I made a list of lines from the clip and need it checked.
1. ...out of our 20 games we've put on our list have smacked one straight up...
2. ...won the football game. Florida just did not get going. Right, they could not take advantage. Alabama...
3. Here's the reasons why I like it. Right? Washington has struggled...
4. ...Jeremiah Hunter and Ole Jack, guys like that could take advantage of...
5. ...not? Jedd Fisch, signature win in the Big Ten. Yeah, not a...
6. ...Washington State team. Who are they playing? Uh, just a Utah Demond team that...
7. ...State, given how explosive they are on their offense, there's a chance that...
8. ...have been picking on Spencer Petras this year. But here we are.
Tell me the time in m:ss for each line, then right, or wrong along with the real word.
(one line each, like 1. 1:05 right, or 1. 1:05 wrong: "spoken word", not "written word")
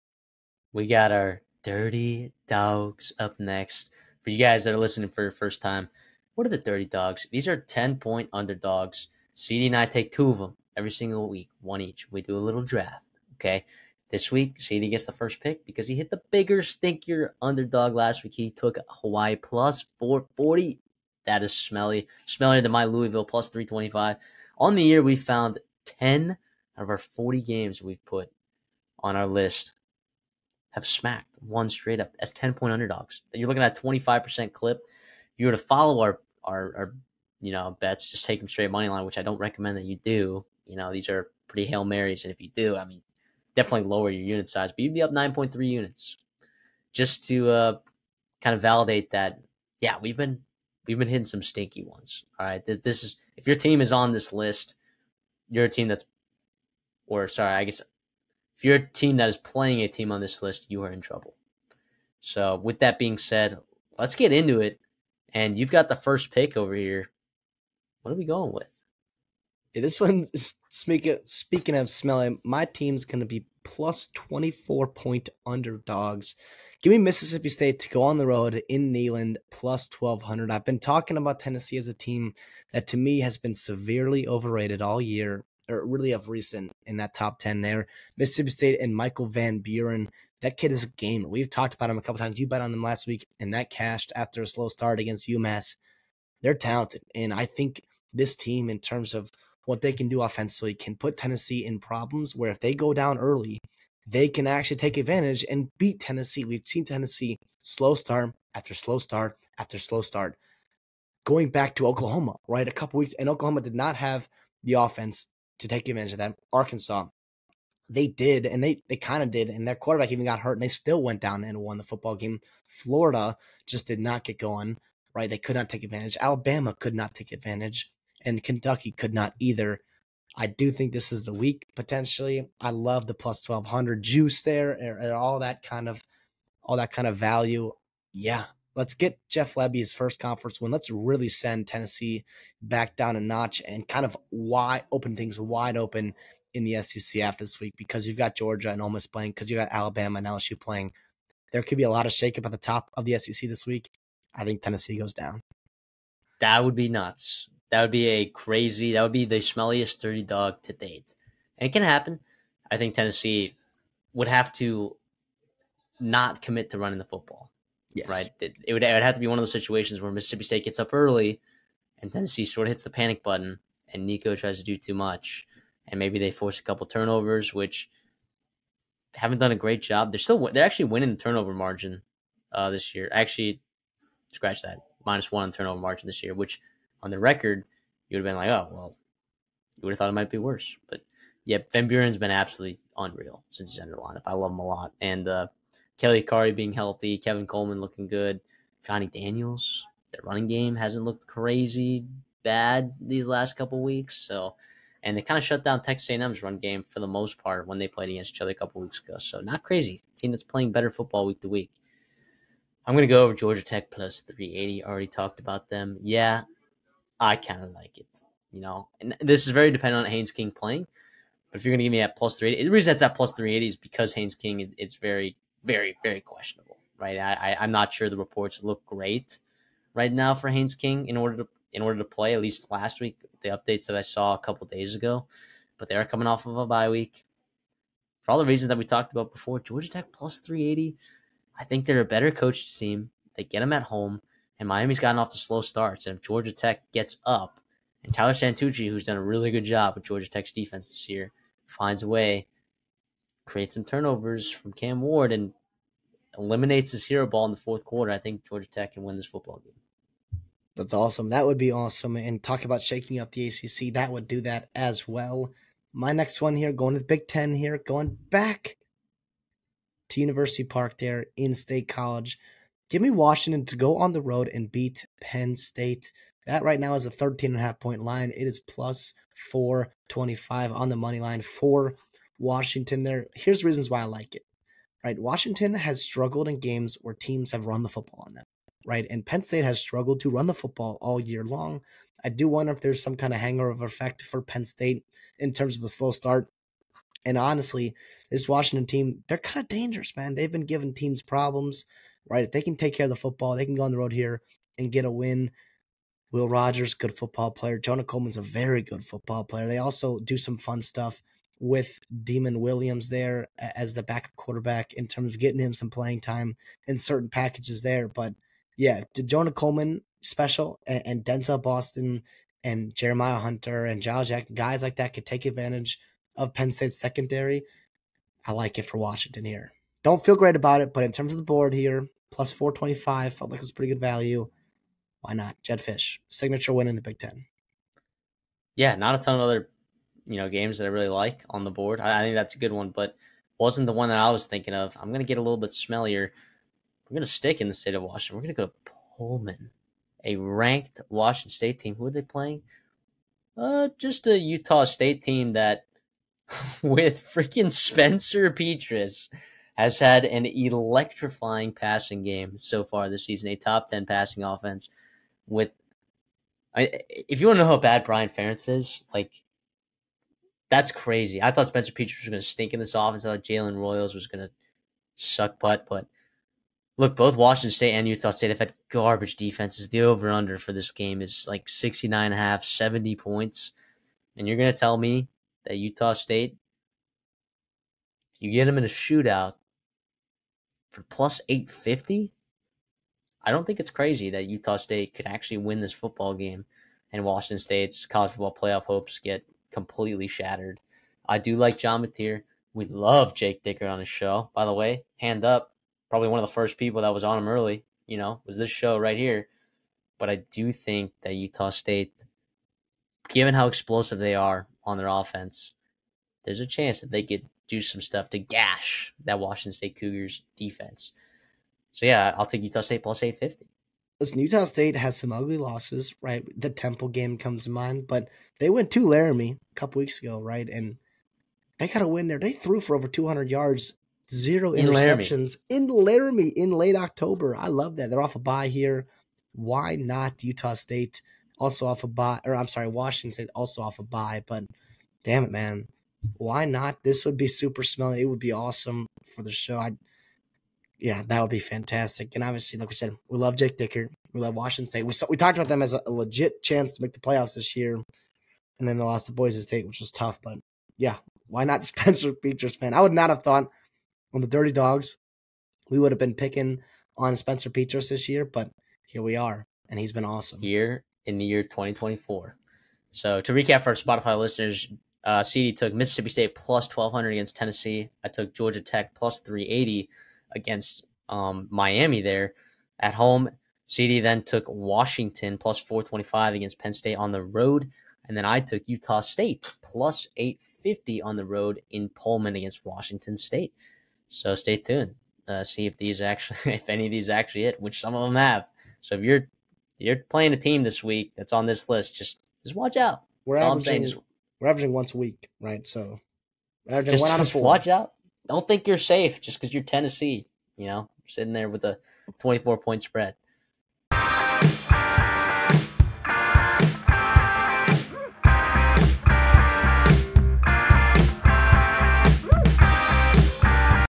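1. 0:26 wrong: "40", not "20"
2. 2:01 right
3. 4:43 right
4. 5:22 wrong: "Giles", not "Ole"
5. 5:35 right
6. 5:51 wrong: "State", not "Demond"
7. 6:51 right
8. 7:46 right.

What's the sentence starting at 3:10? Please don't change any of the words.
But yeah, Van Buren's been absolutely unreal since he's entered the lineup.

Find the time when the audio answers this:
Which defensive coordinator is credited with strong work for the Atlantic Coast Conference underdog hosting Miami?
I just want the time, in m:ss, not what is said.
4:08.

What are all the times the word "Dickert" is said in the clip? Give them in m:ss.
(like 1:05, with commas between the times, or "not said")
6:43, 7:33.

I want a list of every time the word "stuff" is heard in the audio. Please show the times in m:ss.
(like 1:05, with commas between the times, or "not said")
5:10, 6:58.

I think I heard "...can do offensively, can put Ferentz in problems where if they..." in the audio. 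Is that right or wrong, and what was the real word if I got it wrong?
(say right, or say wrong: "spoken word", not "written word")
wrong: "Tennessee", not "Ferentz".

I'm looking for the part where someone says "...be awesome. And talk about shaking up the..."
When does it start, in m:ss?
4:21.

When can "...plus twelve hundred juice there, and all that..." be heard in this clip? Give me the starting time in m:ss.
2:13.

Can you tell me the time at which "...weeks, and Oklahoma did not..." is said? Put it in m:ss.
1:52.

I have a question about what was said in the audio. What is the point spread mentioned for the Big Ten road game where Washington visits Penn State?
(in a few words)
13.5.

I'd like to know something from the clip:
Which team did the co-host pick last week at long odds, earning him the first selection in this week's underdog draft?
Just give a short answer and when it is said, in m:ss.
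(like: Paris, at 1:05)
Hawaii, at 0:18.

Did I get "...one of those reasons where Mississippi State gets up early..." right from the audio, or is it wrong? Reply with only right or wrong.
wrong.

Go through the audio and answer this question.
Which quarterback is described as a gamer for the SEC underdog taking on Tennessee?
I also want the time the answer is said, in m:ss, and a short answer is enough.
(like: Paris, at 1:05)
Michael Van Buren, at 1:28.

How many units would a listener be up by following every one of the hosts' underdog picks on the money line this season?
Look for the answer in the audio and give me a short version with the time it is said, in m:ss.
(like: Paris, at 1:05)
9.3, at 0:45.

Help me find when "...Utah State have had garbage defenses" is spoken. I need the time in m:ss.
6:18.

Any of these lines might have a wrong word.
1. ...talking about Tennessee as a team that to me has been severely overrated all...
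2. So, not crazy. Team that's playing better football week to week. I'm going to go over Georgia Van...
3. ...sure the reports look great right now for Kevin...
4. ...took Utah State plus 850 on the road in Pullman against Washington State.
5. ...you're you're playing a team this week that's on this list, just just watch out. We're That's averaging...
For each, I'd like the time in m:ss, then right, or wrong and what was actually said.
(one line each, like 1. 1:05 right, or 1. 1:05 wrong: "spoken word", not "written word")
1. 1:20 right
2. 3:29 wrong: "Tech", not "Van"
3. 3:47 wrong: "Haynes", not "Kevin"
4. 8:08 right
5. 8:19 right.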